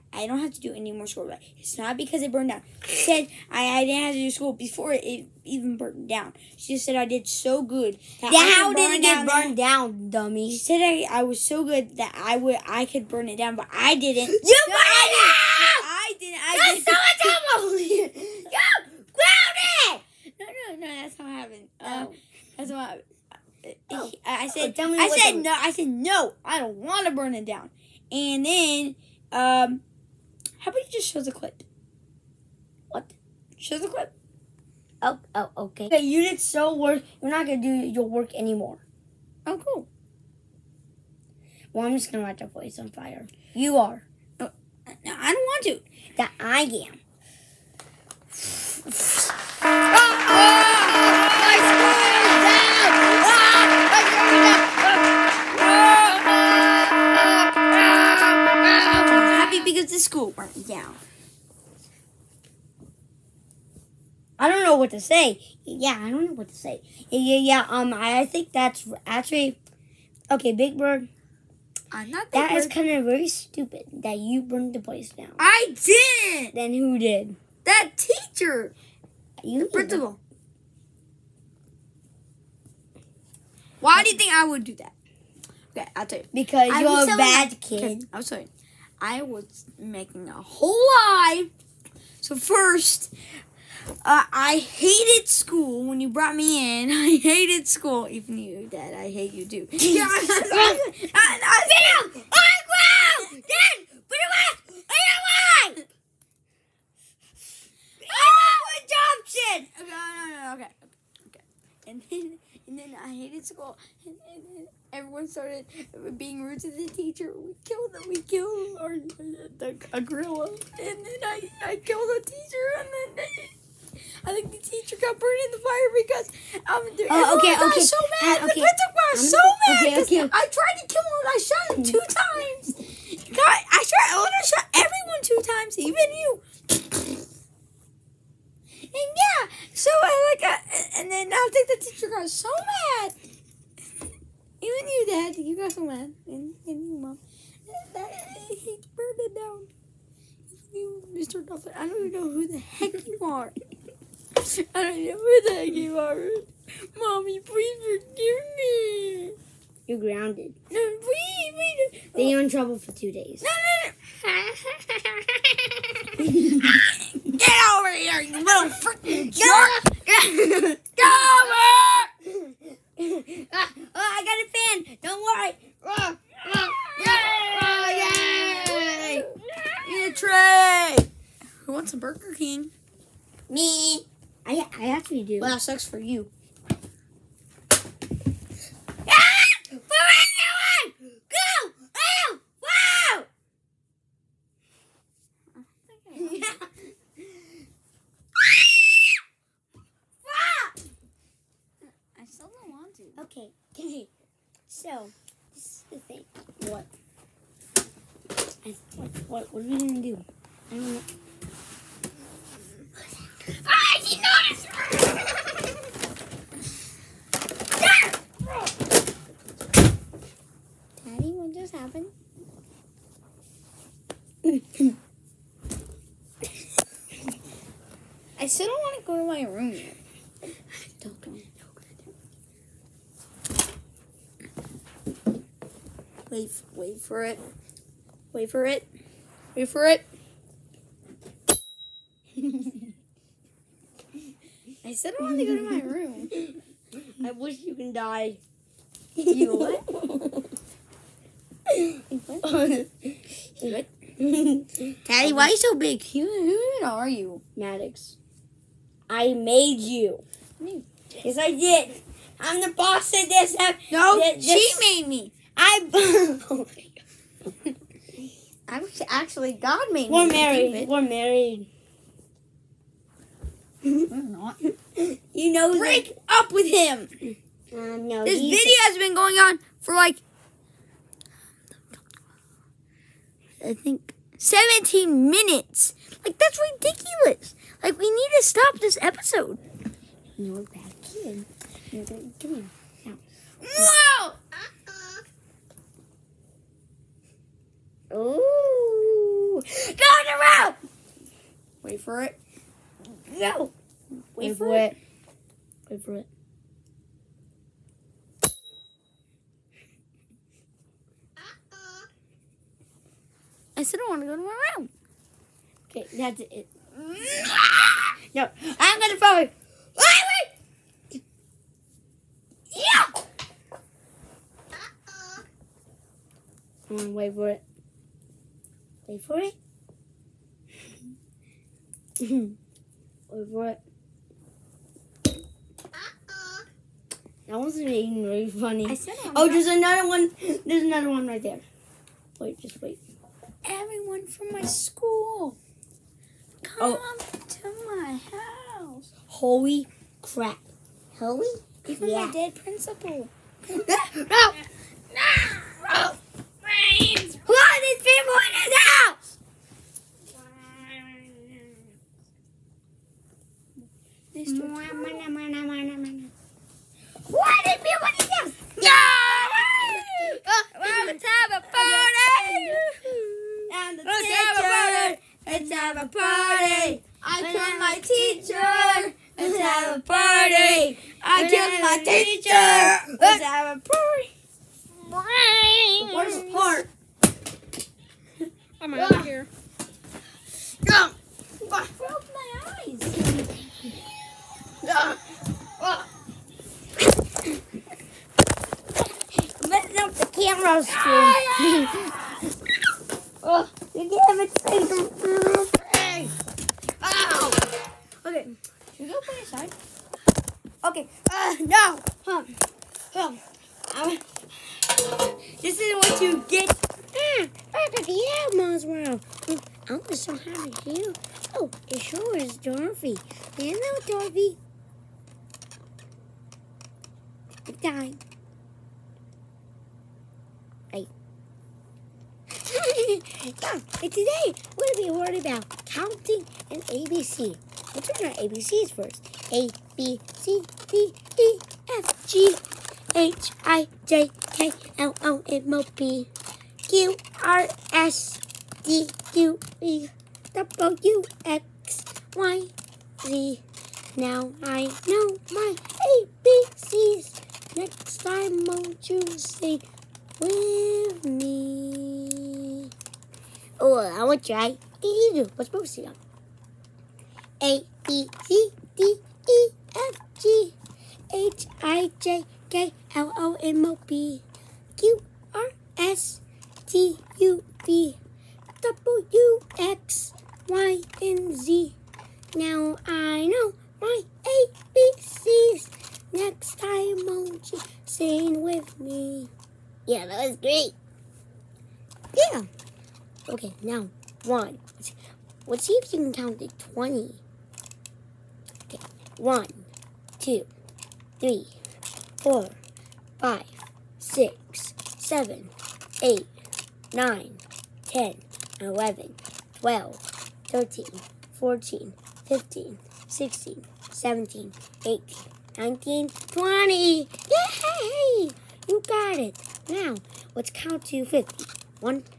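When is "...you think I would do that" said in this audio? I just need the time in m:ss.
1:24.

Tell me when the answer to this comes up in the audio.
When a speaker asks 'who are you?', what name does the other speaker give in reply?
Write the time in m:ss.
4:17.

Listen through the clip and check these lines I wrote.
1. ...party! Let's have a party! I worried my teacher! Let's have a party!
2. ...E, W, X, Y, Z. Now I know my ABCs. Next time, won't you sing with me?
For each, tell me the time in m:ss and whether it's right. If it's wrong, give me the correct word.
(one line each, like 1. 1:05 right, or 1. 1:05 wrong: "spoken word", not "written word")
1. 6:14 wrong: "killed", not "worried"
2. 7:29 right.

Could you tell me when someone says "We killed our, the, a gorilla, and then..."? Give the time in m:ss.
1:58.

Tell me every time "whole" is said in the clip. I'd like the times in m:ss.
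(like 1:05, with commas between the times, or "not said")
1:30.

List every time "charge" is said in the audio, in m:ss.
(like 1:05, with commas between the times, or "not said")
not said.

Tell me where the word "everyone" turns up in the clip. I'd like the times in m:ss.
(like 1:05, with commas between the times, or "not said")
1:54, 2:14, 5:43.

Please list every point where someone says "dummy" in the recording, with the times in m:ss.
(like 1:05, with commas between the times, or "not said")
0:10.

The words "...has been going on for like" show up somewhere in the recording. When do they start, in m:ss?
4:38.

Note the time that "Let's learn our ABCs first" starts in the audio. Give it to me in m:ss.
7:17.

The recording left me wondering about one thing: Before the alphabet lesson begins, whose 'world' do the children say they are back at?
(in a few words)
Elmo's world.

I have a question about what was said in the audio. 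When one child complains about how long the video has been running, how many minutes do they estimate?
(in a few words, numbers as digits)
17.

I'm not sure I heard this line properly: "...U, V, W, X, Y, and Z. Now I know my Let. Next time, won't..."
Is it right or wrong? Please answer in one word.
wrong.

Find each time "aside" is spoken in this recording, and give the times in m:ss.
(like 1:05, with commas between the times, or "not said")
6:49.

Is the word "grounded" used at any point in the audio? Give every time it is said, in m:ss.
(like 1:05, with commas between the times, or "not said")
0:19, 2:39.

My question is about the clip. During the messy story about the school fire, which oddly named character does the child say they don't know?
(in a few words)
Mr. Dolphin.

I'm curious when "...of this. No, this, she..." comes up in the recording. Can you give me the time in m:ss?
4:23.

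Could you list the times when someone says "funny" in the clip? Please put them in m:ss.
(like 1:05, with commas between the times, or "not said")
5:38.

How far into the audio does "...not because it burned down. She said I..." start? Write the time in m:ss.
0:01.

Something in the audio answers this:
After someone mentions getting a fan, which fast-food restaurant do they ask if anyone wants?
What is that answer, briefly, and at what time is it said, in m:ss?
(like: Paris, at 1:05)
Burger King, at 3:01.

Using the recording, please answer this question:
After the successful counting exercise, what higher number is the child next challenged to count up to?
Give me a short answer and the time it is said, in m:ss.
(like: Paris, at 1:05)
50, at 8:41.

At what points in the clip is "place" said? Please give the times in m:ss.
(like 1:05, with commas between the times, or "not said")
0:42, 1:14.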